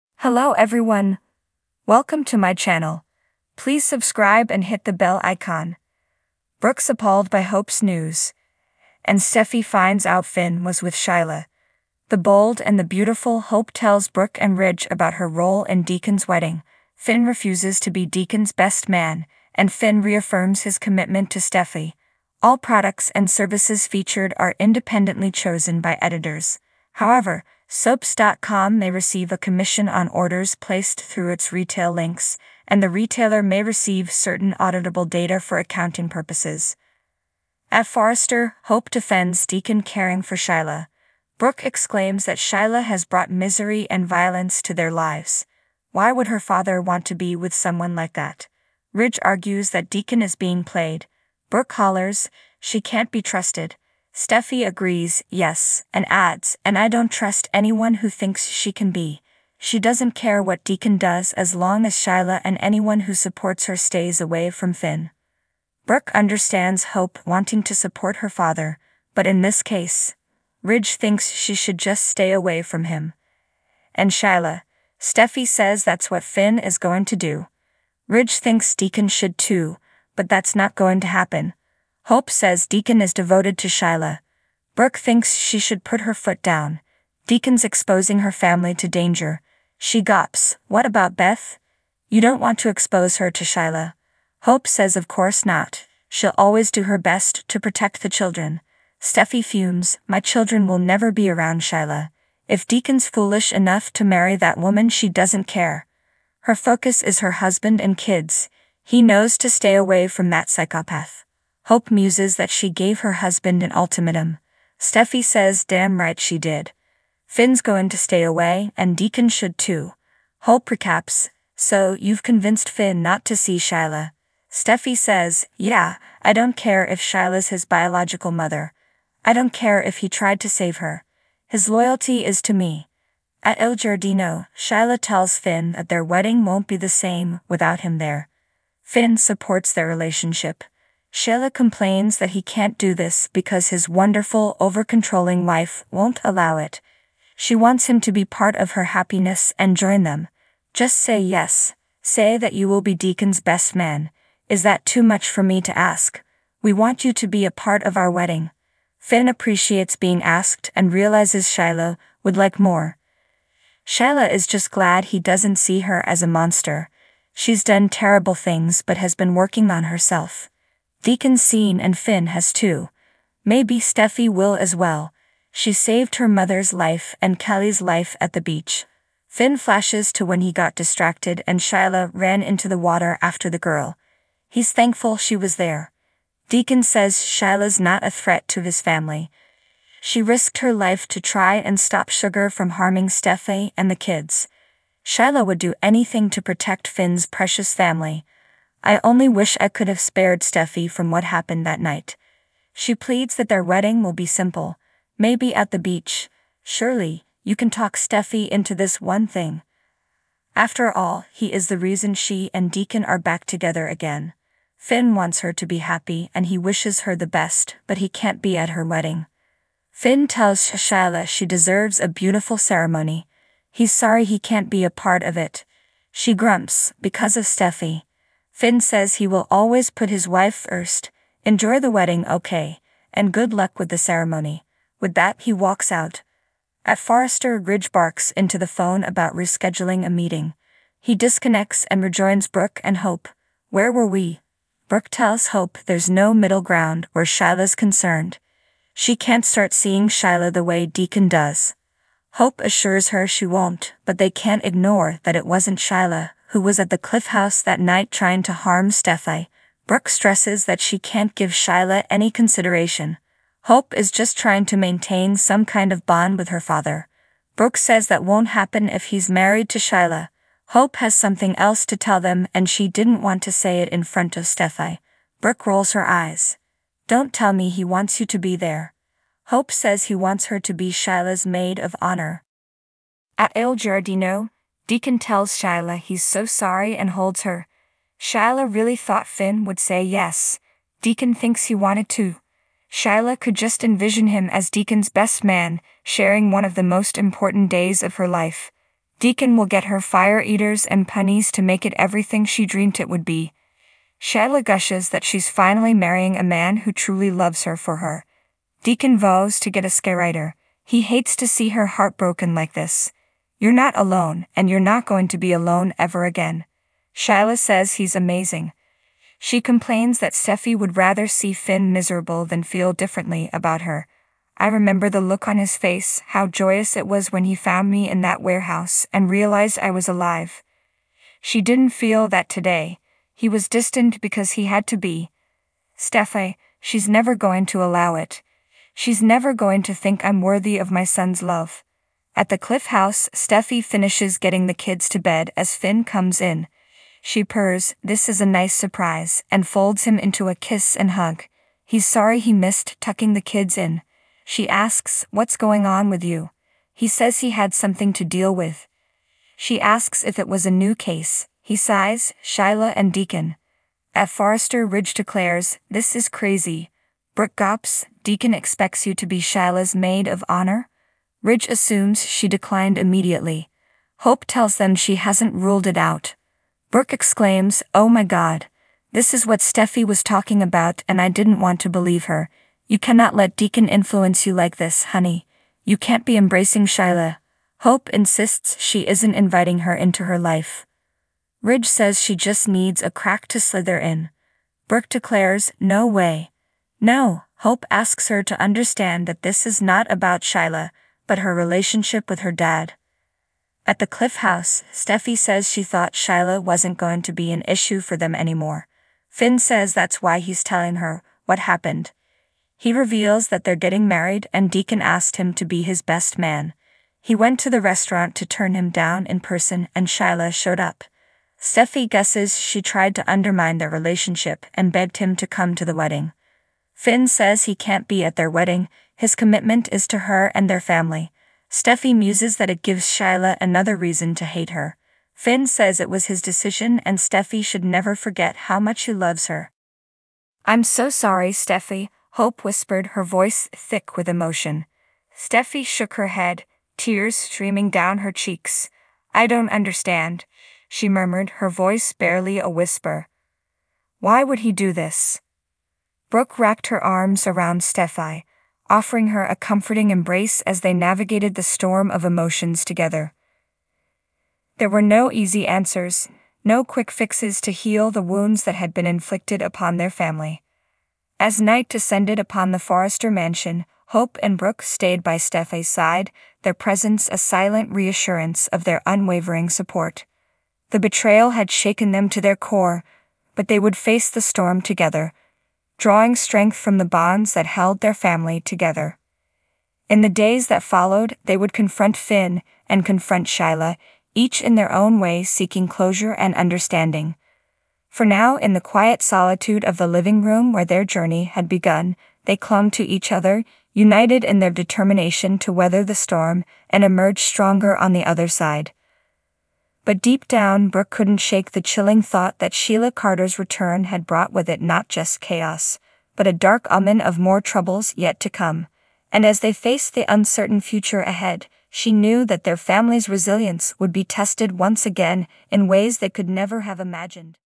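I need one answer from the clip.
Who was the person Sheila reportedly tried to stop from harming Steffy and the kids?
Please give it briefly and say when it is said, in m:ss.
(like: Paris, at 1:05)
Sugar, at 3:12.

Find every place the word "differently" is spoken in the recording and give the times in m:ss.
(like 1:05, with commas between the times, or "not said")
5:22.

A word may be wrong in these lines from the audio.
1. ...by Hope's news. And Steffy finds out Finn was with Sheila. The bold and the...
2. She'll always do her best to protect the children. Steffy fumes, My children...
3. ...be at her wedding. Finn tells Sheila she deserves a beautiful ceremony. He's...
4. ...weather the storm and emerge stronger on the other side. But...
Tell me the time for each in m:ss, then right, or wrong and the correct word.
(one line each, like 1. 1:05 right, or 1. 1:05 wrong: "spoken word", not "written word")
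1. 0:07 right
2. 1:36 right
3. 3:38 right
4. 8:25 right.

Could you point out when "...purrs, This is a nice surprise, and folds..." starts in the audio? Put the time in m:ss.
5:47.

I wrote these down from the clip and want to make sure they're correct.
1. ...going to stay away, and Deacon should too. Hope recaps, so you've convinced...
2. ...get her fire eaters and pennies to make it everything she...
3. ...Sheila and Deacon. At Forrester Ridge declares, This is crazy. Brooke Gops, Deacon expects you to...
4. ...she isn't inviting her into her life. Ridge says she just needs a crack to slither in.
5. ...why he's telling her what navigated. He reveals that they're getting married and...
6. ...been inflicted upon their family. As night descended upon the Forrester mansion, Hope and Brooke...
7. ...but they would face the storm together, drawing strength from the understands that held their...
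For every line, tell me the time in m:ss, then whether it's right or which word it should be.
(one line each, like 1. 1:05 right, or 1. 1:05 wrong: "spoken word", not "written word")
1. 1:57 right
2. 4:59 right
3. 6:02 right
4. 6:28 right
5. 6:50 wrong: "happened", not "navigated"
6. 7:48 right
7. 8:03 wrong: "bonds", not "understands".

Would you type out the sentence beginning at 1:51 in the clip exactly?
Hope muses that she gave her husband an ultimatum.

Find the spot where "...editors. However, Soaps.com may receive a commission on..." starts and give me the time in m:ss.
0:25.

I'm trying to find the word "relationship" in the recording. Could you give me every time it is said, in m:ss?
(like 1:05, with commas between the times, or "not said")
2:19, 6:41, 7:03.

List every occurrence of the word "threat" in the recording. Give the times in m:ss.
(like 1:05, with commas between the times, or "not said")
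3:08.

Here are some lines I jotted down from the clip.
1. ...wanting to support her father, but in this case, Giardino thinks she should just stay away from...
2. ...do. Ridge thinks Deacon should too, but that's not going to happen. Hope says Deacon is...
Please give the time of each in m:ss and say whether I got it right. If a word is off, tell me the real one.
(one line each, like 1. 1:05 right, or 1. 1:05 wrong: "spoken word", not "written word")
1. 1:07 wrong: "Ridge", not "Giardino"
2. 1:17 right.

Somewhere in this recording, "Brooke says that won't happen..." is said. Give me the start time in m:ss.
4:27.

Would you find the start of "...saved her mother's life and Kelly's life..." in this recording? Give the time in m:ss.
2:55.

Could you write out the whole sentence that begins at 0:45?
Why would her father want to be with someone like that?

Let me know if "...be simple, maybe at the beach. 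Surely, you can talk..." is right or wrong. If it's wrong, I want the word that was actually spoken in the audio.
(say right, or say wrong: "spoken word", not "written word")
right.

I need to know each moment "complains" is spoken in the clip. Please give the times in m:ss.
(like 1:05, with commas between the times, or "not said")
2:21, 5:19.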